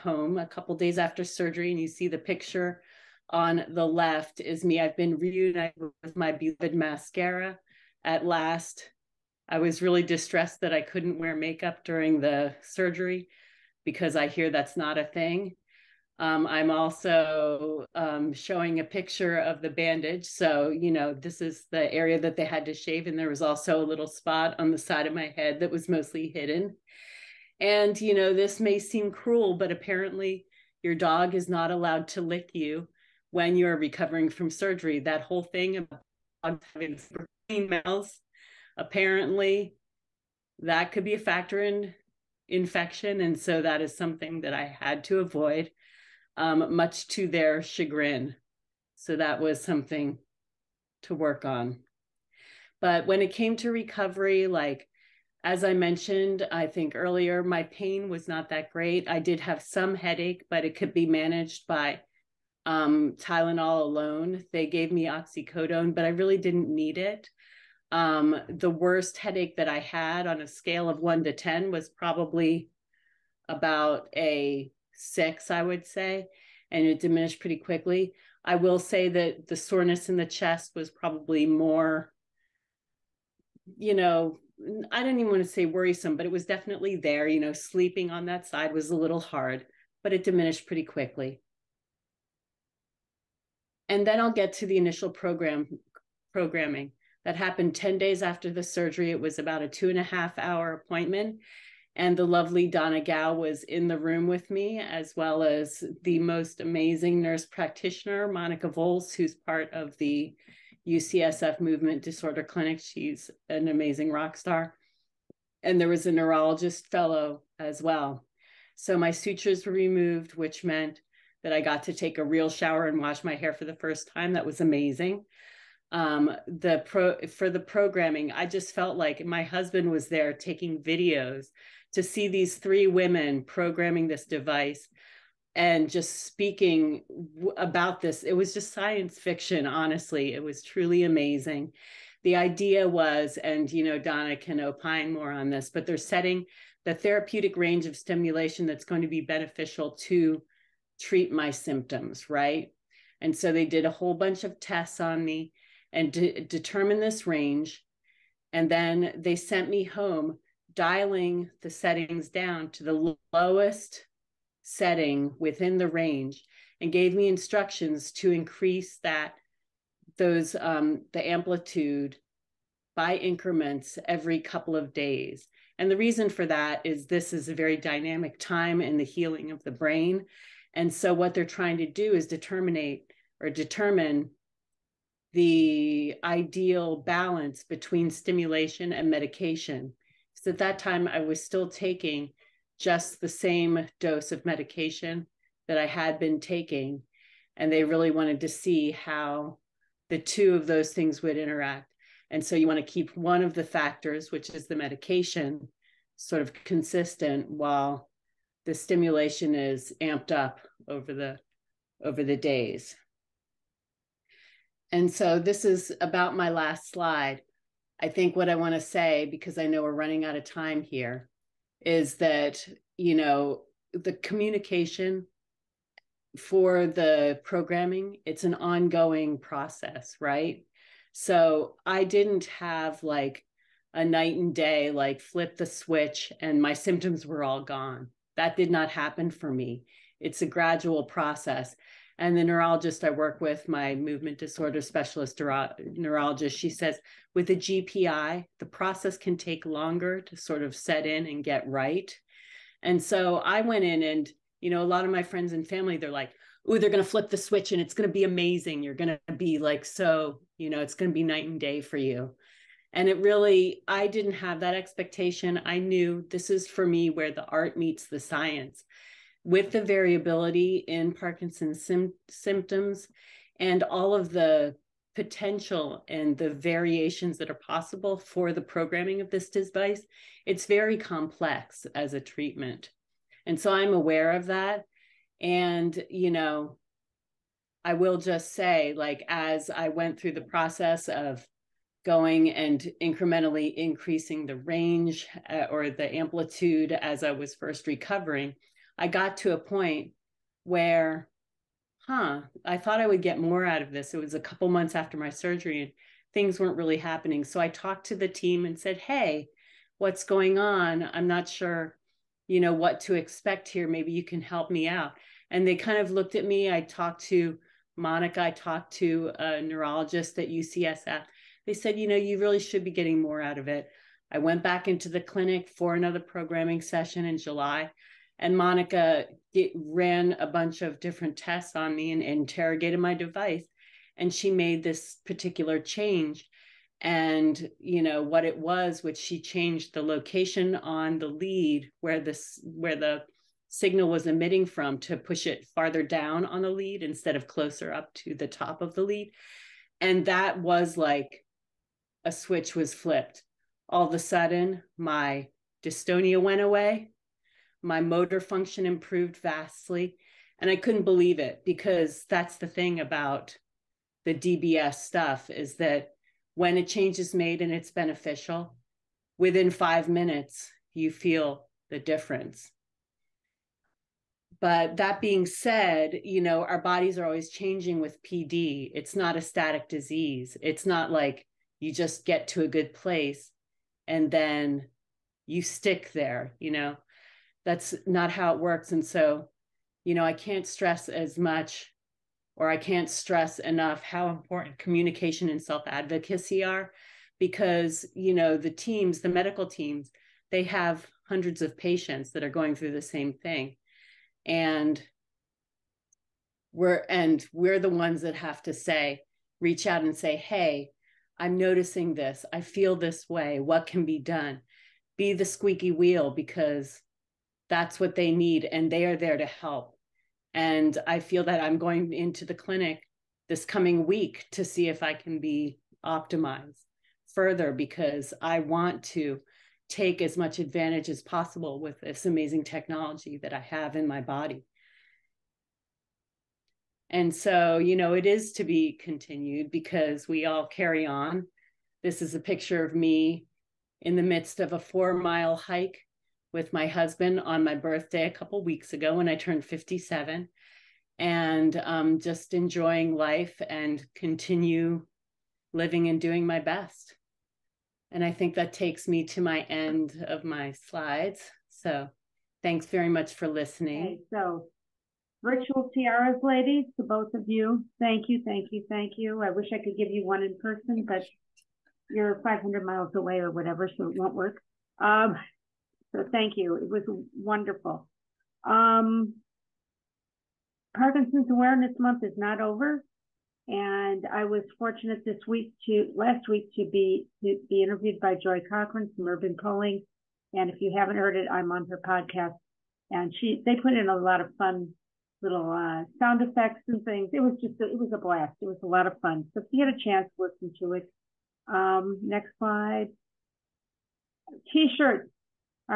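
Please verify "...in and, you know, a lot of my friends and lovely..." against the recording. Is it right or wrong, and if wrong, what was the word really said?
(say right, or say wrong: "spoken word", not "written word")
wrong: "family", not "lovely".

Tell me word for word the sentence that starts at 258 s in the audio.
You're going to be like, so, you know, it's going to be night and day for you.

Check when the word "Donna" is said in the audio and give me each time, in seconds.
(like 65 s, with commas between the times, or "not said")
102 s, 143 s.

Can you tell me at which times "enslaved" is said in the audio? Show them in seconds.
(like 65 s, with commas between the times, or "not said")
not said.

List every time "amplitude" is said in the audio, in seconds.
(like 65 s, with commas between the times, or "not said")
171 s, 296 s.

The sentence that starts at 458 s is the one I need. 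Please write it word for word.
And I think that takes me to my end of my slides.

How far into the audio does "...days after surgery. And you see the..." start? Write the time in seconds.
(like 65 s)
0 s.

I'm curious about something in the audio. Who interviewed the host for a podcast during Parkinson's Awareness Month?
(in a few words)
Joy Cochran.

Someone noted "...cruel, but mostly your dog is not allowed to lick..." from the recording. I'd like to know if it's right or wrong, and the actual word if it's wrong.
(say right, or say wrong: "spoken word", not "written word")
wrong: "apparently", not "mostly".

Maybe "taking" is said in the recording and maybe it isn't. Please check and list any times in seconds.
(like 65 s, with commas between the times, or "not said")
130 s, 191 s, 196 s.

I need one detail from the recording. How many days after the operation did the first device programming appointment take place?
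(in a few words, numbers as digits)
10.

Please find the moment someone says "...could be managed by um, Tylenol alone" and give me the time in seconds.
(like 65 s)
60 s.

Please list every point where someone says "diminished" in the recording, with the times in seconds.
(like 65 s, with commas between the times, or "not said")
76 s, 90 s.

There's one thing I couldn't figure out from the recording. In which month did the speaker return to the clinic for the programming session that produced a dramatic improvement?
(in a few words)
July.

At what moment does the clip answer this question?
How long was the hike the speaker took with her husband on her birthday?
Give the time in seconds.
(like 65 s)
444 s.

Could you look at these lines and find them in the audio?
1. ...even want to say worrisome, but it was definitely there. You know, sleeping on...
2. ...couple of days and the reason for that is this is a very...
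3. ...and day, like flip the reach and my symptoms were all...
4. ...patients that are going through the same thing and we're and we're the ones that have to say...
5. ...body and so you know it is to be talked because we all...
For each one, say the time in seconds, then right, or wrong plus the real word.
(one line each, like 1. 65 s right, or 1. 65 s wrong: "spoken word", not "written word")
1. 85 s right
2. 174 s right
3. 234 s wrong: "switch", not "reach"
4. 401 s right
5. 434 s wrong: "continued", not "talked".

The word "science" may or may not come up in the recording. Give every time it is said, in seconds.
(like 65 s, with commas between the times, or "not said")
138 s, 268 s.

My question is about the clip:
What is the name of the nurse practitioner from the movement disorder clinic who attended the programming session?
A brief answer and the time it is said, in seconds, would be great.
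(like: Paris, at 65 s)
Monica Volz, at 108 s.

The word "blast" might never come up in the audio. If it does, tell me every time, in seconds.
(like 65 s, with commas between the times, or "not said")
498 s.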